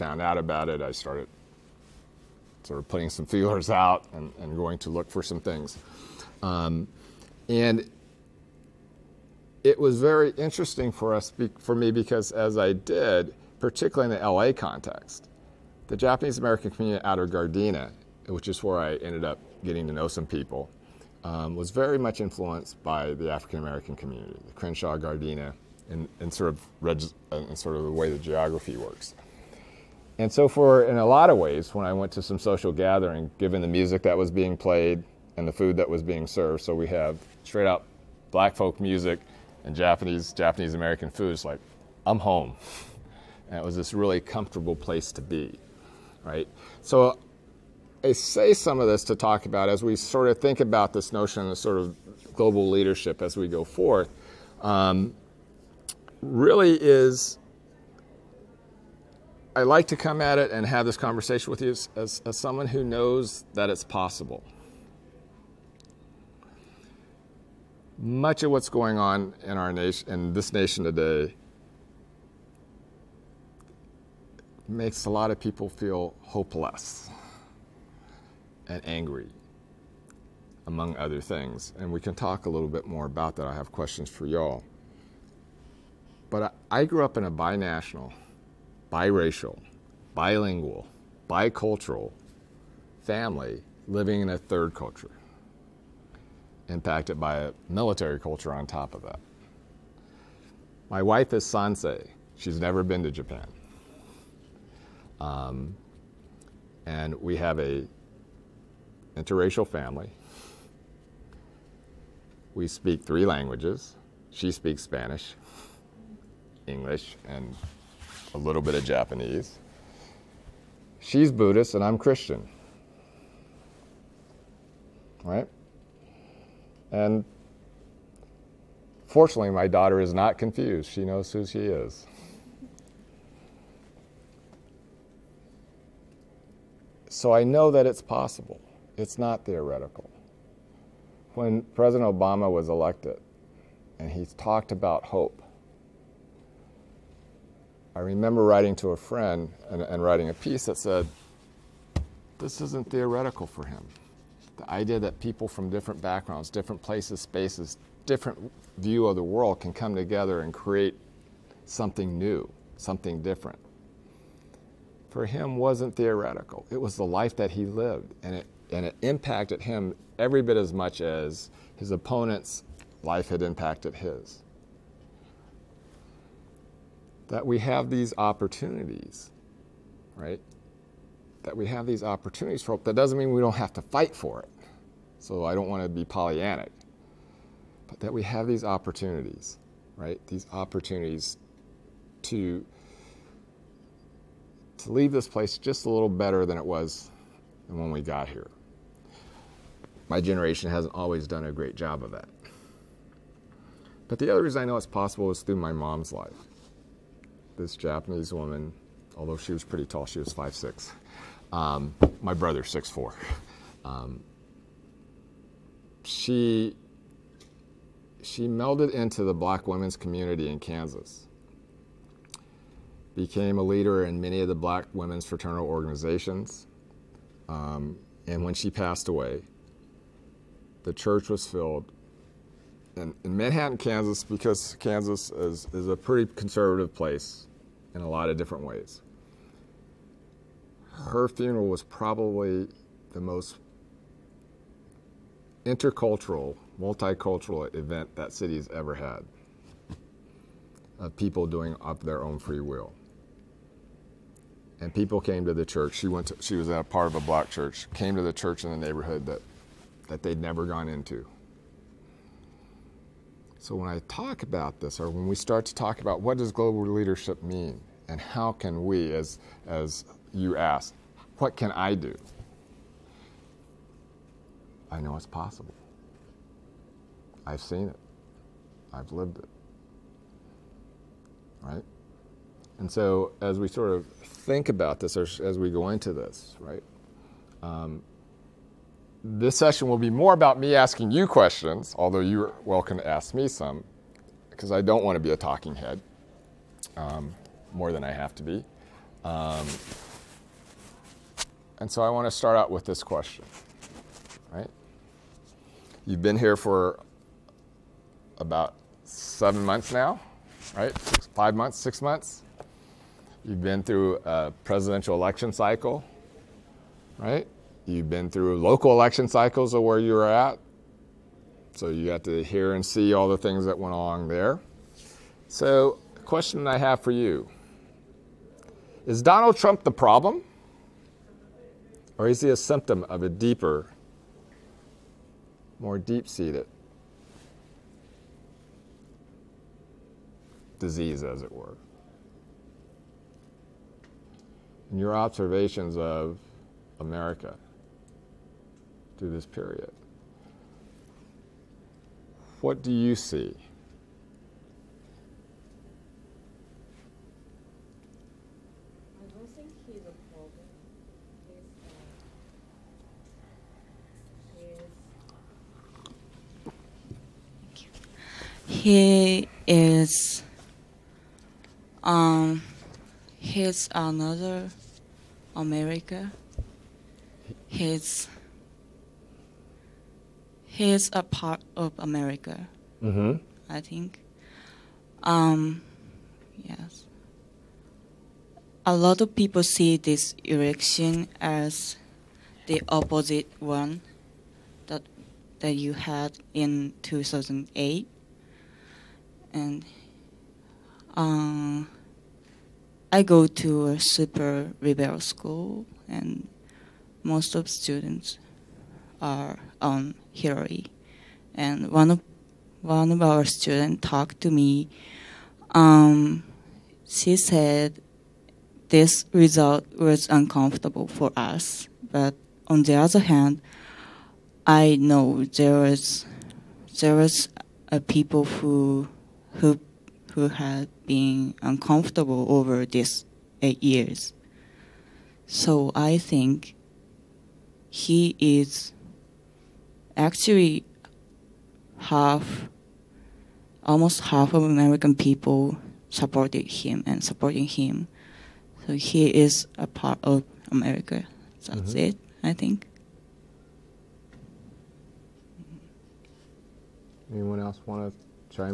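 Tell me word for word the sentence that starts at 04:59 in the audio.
Um, and so, I want to start out with this question, right?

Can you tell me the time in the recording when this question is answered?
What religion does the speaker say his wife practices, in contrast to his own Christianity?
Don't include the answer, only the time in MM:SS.
02:01.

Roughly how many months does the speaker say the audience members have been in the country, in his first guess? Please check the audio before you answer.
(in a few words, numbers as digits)
7.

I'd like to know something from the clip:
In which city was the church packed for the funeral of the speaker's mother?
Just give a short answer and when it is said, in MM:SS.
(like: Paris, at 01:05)
Manhattan, Kansas, at 03:53.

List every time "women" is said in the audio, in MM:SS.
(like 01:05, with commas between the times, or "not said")
03:39, 03:44.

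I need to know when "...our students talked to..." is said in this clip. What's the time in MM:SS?
06:53.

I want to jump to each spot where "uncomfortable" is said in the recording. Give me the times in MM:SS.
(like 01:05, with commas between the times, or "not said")
07:00, 07:11.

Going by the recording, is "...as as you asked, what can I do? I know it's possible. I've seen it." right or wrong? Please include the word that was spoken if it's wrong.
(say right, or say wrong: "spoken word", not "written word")
right.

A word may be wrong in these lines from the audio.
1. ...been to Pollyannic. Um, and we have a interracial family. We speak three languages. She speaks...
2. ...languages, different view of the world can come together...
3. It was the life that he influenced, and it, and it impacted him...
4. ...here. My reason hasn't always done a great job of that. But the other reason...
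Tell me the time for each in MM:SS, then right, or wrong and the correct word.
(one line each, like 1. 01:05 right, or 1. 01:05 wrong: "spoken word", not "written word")
1. 01:42 wrong: "Japan", not "Pollyannic"
2. 02:37 wrong: "spaces", not "languages"
3. 02:46 wrong: "lived", not "influenced"
4. 03:18 wrong: "generation", not "reason".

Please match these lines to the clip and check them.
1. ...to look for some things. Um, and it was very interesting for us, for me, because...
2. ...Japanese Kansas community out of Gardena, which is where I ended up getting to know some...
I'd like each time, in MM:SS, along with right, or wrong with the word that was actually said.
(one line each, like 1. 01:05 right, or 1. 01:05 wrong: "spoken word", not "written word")
1. 00:04 right
2. 00:15 wrong: "American", not "Kansas".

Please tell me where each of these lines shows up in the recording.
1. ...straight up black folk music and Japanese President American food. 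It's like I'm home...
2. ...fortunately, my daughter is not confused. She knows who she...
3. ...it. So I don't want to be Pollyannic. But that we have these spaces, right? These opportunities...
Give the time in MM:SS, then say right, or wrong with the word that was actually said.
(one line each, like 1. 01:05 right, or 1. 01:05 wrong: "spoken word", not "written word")
1. 00:37 wrong: "Japanese", not "President"
2. 02:09 right
3. 03:04 wrong: "opportunities", not "spaces".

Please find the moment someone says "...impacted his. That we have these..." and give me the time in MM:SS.
02:53.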